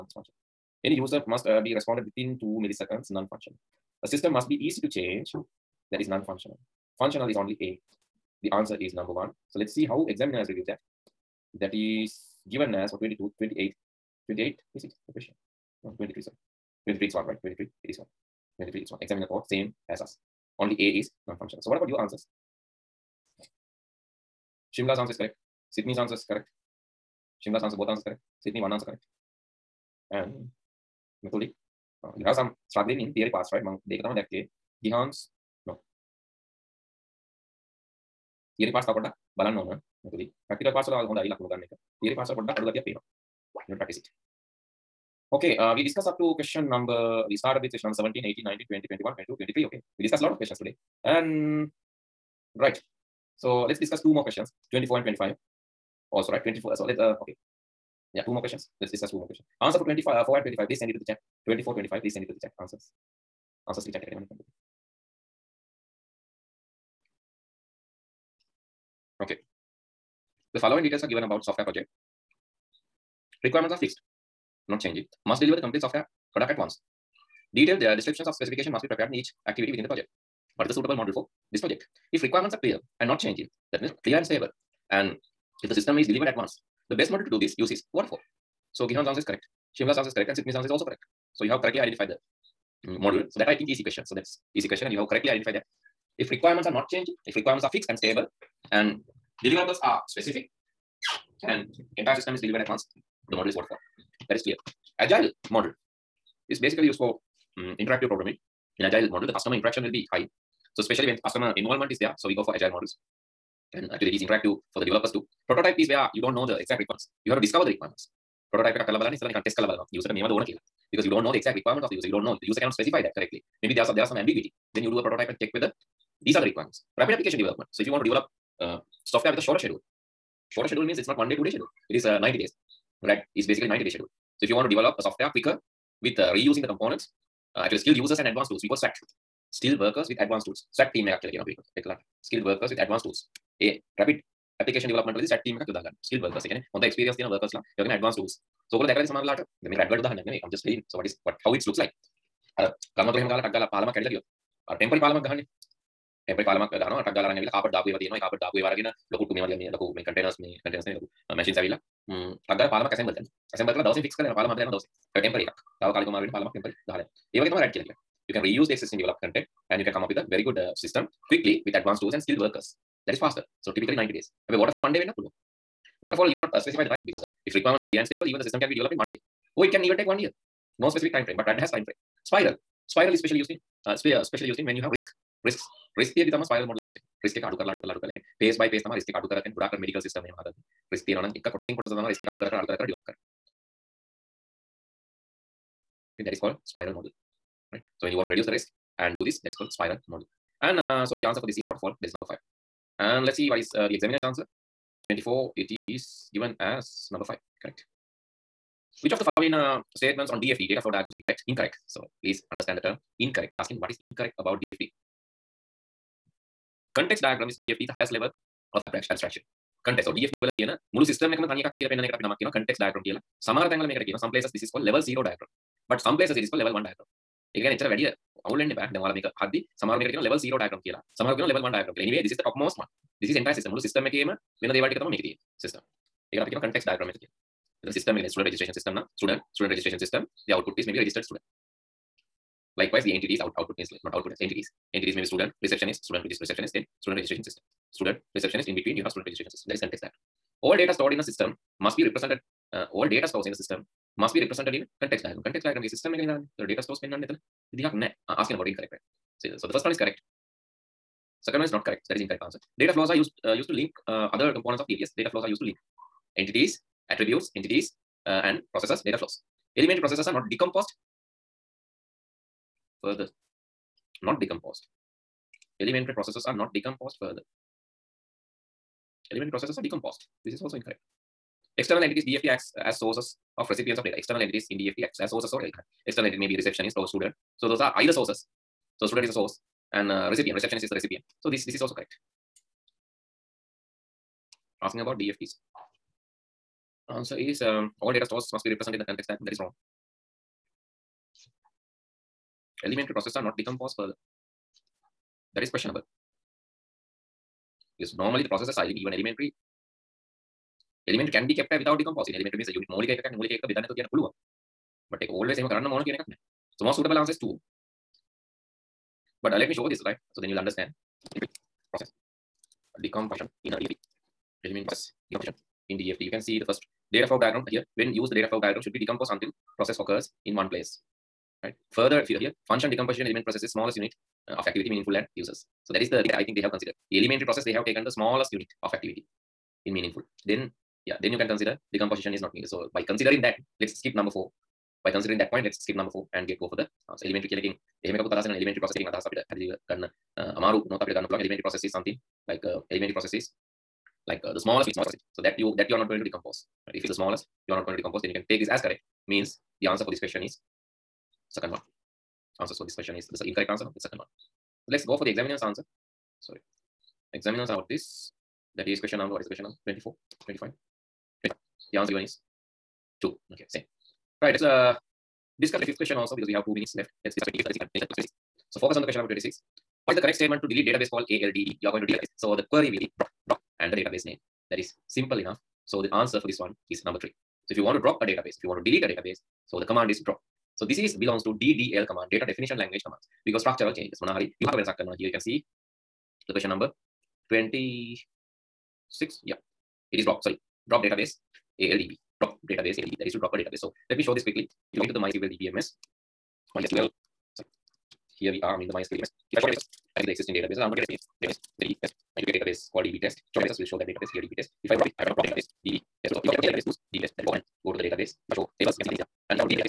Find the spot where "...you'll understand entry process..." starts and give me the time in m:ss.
5:20.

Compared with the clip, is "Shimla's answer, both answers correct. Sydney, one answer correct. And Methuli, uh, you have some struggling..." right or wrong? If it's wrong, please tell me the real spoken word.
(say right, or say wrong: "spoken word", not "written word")
right.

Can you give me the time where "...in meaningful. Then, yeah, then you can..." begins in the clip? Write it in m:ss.
5:39.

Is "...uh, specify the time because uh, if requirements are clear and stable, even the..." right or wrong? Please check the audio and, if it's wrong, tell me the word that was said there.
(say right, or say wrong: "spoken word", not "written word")
right.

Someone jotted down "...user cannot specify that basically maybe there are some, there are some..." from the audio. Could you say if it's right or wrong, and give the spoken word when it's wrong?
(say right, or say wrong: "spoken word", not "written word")
wrong: "correctly", not "basically".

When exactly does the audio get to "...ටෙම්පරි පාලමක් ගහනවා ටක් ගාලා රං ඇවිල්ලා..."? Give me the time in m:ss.
2:36.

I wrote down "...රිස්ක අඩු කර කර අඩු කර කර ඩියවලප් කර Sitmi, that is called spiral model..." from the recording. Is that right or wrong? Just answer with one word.
wrong.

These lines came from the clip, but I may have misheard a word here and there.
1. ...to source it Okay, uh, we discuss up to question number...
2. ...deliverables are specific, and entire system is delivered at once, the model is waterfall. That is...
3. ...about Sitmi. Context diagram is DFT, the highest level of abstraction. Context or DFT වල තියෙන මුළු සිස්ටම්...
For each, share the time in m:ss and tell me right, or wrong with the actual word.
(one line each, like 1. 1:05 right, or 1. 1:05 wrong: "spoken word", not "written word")
1. 0:43 wrong: "practice", not "source"
2. 1:39 right
3. 3:34 wrong: "DFD", not "Sitmi".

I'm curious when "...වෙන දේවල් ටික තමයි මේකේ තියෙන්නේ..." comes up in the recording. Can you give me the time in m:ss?
3:54.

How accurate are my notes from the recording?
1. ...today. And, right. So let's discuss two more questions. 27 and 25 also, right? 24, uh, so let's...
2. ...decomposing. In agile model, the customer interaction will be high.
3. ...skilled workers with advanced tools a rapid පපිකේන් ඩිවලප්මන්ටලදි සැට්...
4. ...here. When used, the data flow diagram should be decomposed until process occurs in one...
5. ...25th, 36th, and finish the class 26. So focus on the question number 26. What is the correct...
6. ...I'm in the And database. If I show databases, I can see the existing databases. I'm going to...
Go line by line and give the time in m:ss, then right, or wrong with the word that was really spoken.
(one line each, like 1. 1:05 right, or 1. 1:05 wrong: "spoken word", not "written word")
1. 0:50 wrong: "24", not "27"
2. 1:48 wrong: "programming", not "decomposing"
3. 2:22 right
4. 5:27 right
5. 6:17 right
6. 6:48 wrong: "MySQL", not "And".